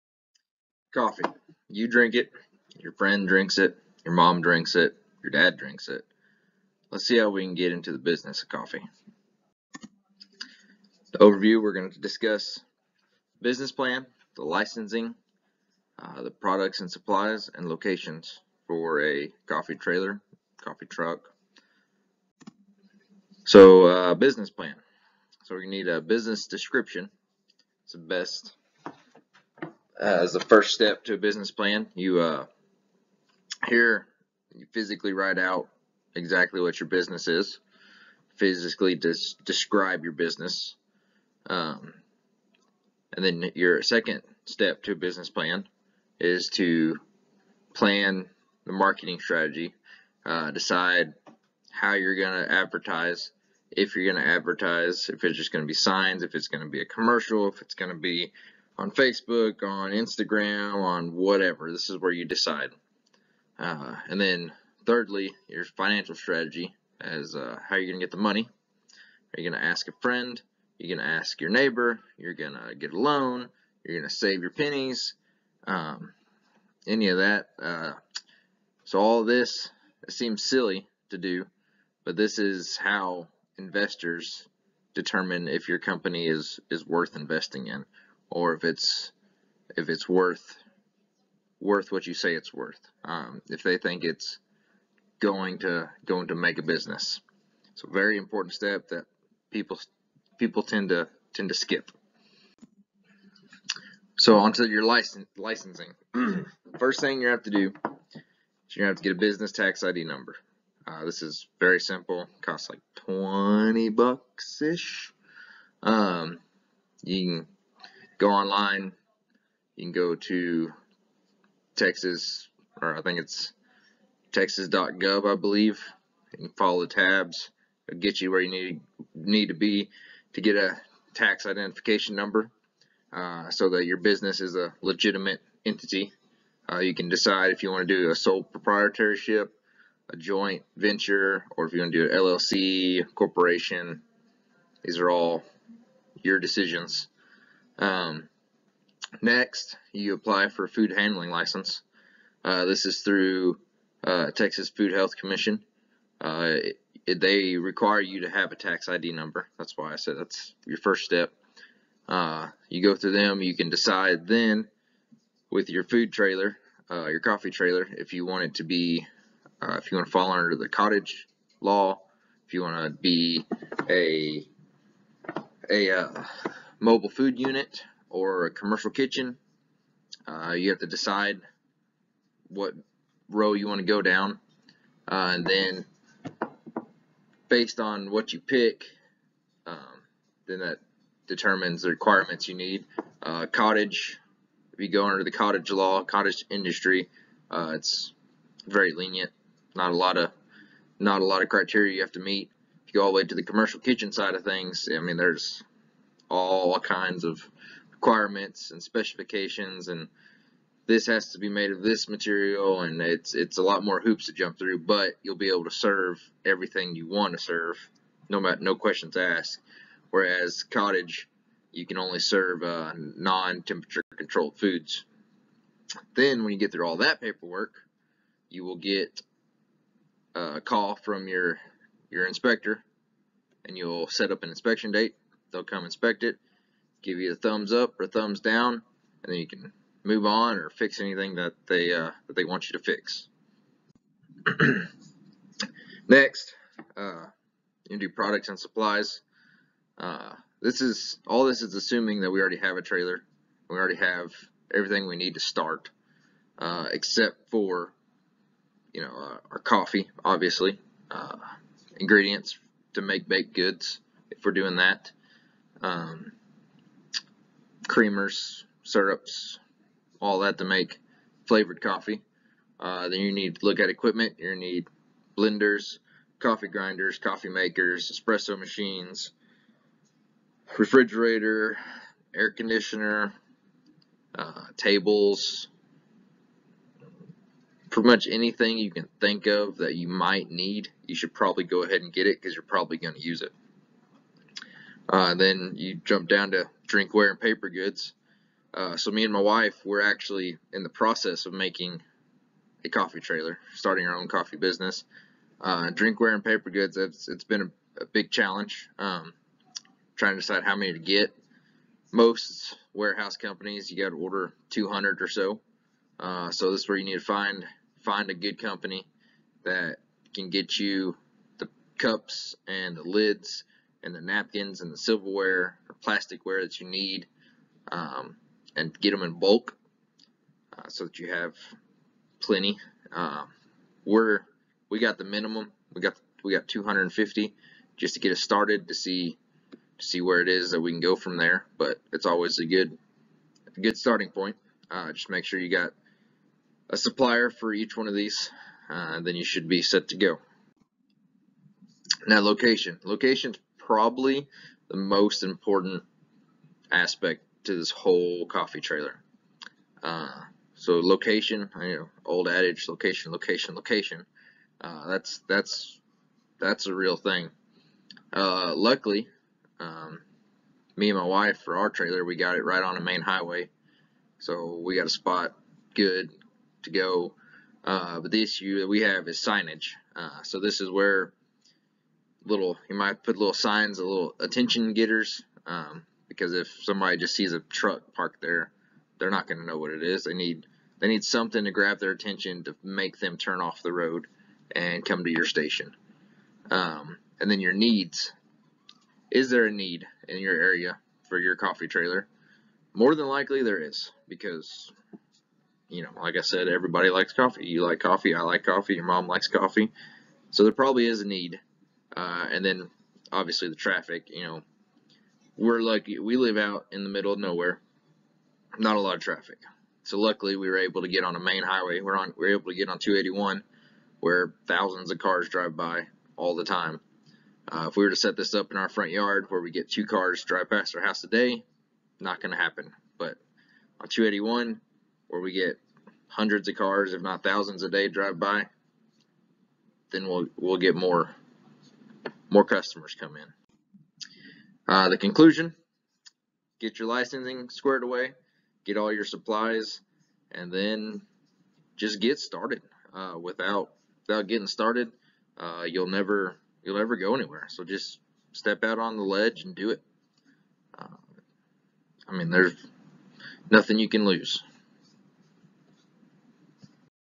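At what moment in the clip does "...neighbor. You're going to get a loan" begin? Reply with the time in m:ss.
1:11.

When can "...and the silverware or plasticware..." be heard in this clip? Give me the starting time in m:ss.
5:24.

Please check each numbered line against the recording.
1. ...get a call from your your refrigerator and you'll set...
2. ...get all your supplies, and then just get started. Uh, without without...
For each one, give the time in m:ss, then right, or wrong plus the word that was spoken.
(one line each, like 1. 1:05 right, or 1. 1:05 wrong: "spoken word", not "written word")
1. 3:48 wrong: "inspector", not "refrigerator"
2. 7:28 right.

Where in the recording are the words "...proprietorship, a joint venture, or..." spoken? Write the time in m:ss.
2:18.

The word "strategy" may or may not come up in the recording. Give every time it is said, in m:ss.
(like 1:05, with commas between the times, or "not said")
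0:49, 1:06.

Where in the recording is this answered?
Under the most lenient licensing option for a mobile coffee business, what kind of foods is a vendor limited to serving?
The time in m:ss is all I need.
3:42.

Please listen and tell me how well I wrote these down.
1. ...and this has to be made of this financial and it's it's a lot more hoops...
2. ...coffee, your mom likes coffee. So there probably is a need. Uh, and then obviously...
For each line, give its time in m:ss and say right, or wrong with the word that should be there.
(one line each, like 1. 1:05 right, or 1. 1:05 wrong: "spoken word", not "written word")
1. 3:29 wrong: "material", not "financial"
2. 6:48 right.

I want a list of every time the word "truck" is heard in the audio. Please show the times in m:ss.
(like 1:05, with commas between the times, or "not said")
0:20, 6:27.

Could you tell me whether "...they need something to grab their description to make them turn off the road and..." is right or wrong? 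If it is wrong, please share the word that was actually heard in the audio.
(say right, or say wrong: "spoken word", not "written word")
wrong: "attention", not "description".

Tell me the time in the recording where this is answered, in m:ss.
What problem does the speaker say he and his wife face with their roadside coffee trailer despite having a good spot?
6:19.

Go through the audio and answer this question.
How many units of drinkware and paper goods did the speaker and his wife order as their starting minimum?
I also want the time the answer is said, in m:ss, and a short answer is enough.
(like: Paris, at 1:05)
250, at 5:36.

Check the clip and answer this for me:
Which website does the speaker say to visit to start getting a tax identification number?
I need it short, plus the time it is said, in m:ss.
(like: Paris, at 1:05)
texas.gov, at 2:04.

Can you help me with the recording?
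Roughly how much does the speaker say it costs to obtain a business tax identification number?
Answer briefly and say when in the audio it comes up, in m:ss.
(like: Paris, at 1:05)
$20, at 1:53.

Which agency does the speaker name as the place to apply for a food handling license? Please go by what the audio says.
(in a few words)
Texas Food Health Commission.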